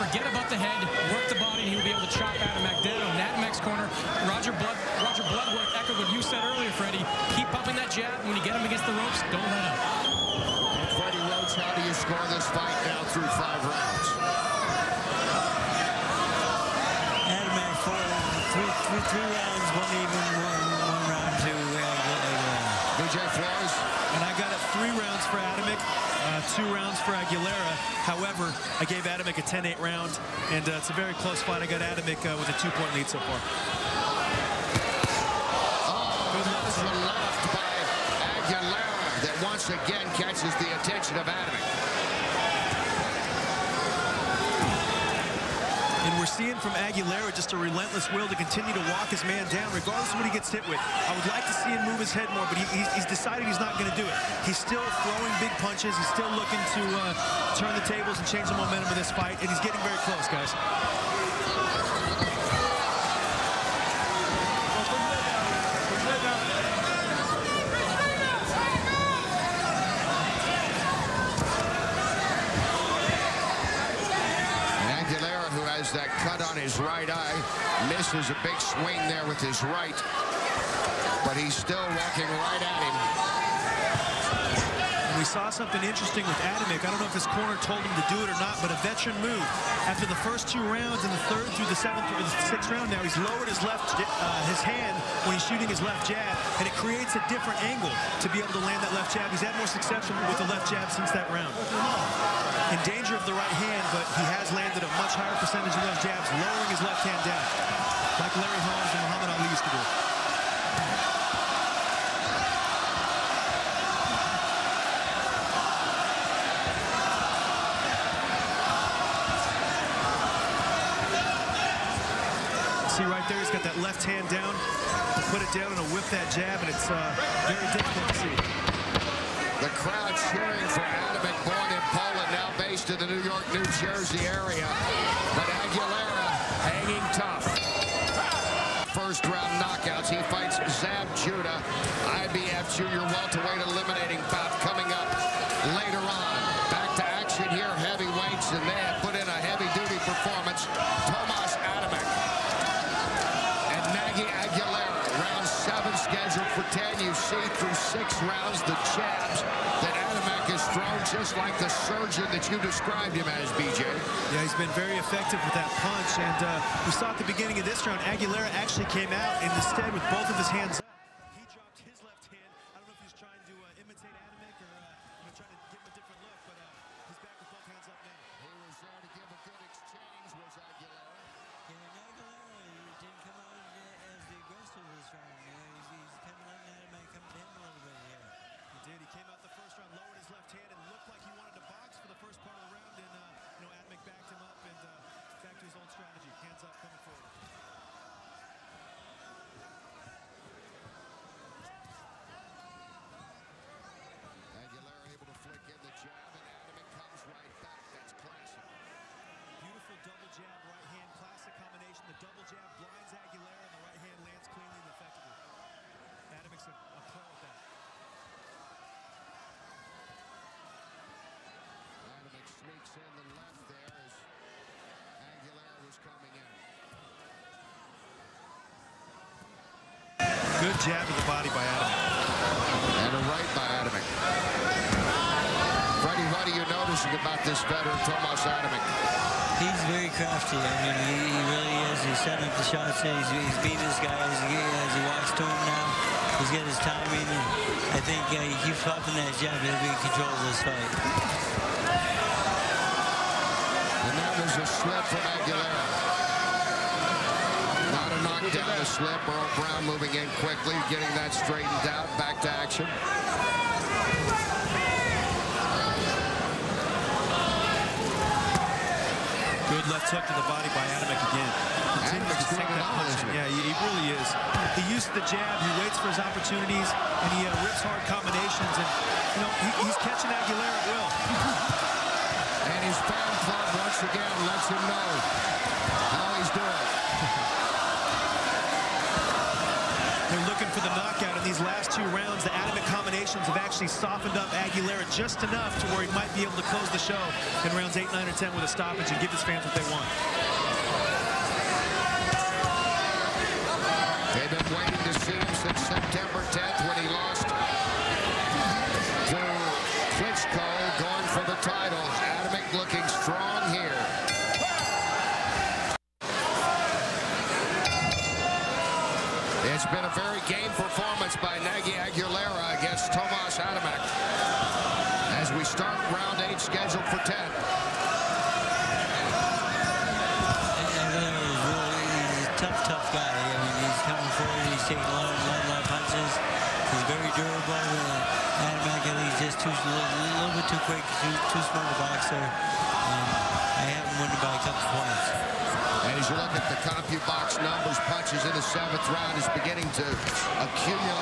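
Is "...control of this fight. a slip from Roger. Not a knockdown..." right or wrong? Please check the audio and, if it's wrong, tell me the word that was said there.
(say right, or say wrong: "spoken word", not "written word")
wrong: "Aguilera", not "Roger".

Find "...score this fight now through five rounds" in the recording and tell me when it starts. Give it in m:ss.
0:11.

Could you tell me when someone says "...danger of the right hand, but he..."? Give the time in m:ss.
1:42.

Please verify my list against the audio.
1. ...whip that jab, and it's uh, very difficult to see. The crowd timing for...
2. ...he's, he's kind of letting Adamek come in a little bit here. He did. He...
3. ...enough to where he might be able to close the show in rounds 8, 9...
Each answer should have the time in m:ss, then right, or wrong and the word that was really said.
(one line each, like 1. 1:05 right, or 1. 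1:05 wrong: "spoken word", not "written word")
1. 2:05 wrong: "cheering", not "timing"
2. 3:05 right
3. 4:55 right.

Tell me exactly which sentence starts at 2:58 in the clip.
He was there to give a good exchange, was Aguilera.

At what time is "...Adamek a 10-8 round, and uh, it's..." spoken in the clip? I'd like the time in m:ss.
0:29.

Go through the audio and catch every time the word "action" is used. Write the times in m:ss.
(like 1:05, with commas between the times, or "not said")
2:27, 4:22.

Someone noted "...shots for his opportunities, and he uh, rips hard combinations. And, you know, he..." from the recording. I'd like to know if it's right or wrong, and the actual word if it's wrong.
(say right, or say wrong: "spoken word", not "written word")
wrong: "waits", not "shots".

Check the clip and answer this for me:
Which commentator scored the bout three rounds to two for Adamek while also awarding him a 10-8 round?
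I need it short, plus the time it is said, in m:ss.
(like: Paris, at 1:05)
BJ Flores, at 0:22.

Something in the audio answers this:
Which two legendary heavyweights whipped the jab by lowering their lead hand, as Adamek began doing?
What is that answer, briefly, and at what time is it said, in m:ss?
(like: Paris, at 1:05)
Larry Holmes and Muhammad Ali, at 1:48.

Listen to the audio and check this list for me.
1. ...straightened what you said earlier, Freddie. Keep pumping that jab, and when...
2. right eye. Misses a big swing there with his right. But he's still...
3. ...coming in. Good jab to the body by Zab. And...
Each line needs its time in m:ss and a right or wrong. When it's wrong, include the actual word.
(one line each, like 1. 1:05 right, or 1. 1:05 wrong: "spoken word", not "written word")
1. 0:05 wrong: "echoed", not "straightened"
2. 1:16 right
3. 3:45 wrong: "Adam", not "Zab".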